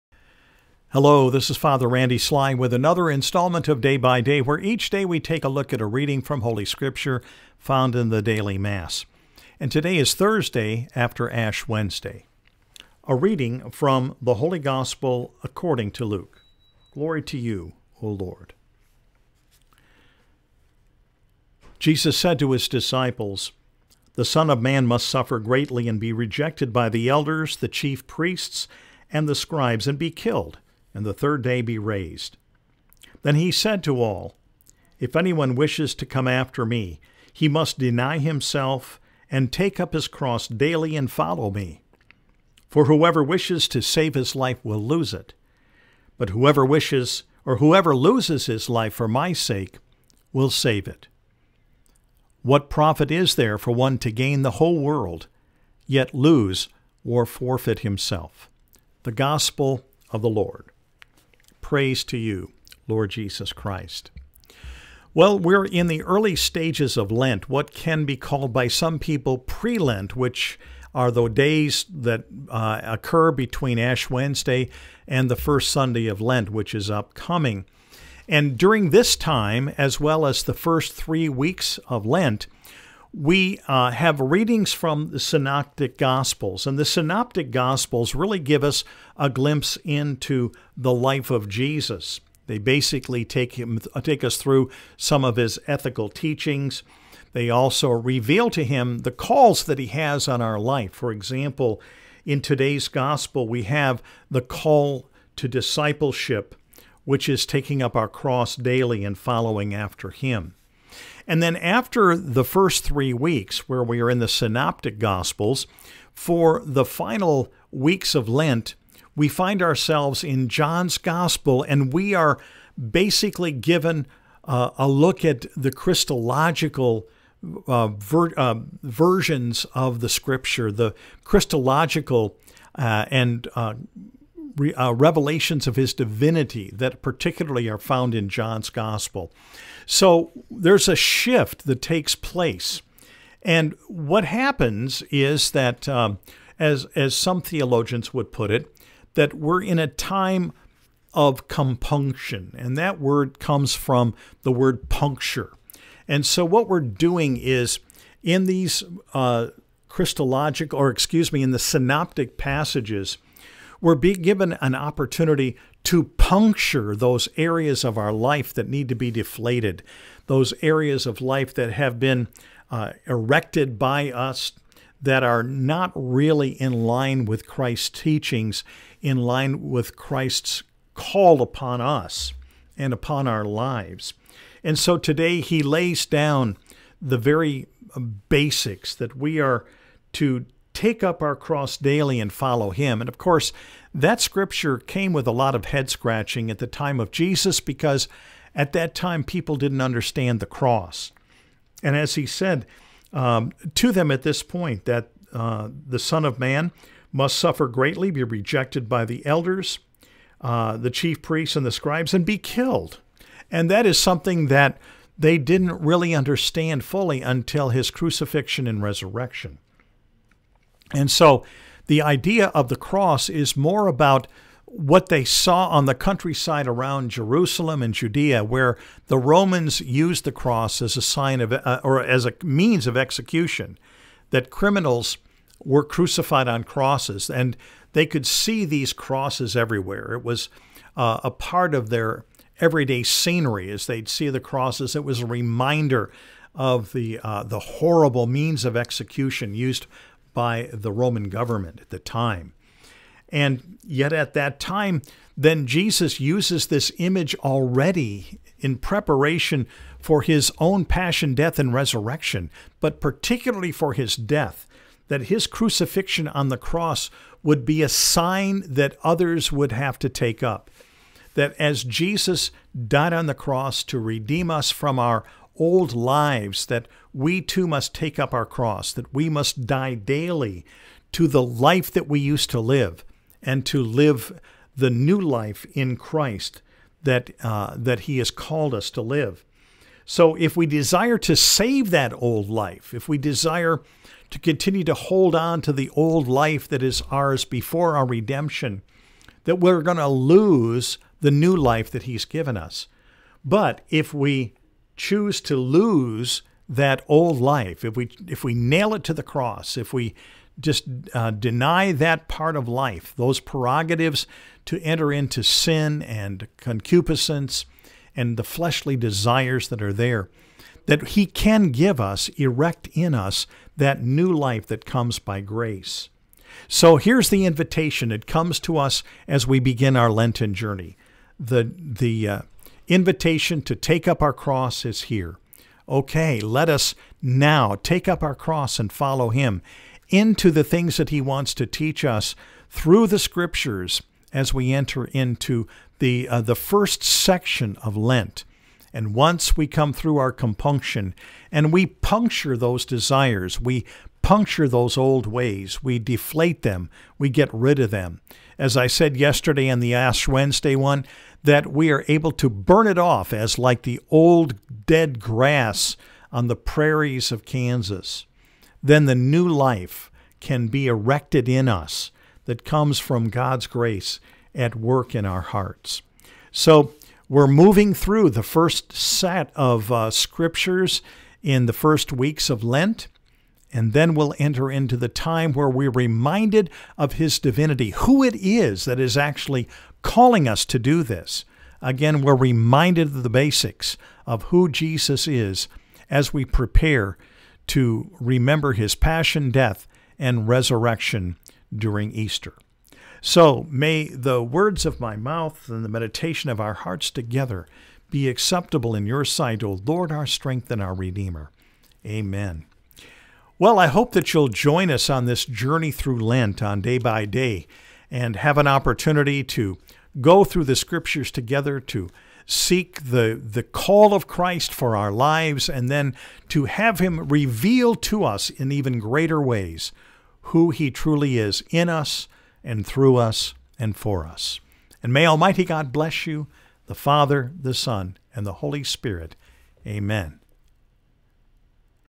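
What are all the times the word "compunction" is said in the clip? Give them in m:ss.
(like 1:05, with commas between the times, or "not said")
2:31, 5:50.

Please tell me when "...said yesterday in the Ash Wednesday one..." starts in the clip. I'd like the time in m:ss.
5:58.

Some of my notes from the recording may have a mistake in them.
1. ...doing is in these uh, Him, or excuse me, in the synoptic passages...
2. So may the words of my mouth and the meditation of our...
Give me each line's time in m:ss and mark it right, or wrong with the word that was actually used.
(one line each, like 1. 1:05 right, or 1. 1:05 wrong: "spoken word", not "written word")
1. 2:36 wrong: "Christologic", not "Him"
2. 6:43 right.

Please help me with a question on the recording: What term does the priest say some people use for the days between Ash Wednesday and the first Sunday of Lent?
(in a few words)
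Pre Lent.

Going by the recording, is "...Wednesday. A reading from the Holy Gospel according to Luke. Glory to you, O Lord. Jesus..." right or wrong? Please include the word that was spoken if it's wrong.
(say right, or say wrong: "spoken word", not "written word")
right.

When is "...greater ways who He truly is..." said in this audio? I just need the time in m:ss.
7:08.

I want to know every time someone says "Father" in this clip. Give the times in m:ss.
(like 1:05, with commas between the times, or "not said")
0:01, 7:16.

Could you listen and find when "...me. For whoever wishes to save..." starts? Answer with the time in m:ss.
0:41.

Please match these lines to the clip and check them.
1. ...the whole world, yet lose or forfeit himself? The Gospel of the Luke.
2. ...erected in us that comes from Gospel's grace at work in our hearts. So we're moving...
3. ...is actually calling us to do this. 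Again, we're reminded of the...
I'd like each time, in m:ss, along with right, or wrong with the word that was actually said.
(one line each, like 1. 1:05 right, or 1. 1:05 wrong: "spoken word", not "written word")
1. 0:54 wrong: "Lord", not "Luke"
2. 6:10 wrong: "God", not "Gospel"
3. 6:28 right.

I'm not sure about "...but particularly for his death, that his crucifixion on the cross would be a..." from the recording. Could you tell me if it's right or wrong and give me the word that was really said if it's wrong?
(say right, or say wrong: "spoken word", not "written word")
right.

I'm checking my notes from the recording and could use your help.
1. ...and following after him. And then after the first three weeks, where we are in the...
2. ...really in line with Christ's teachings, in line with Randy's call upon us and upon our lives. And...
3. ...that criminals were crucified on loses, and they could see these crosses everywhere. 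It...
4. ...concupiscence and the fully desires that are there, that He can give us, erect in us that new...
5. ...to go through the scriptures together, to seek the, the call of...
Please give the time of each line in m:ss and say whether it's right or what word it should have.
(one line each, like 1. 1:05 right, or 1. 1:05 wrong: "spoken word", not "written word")
1. 1:49 right
2. 2:55 wrong: "Christ", not "Randy"
3. 3:54 wrong: "crosses", not "loses"
4. 5:16 wrong: "fleshly", not "fully"
5. 6:59 right.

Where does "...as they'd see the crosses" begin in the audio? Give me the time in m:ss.
4:03.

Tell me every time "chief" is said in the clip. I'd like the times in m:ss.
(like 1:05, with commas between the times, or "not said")
0:27, 3:30.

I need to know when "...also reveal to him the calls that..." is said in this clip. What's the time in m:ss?
1:37.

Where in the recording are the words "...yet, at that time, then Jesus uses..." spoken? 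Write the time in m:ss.
4:13.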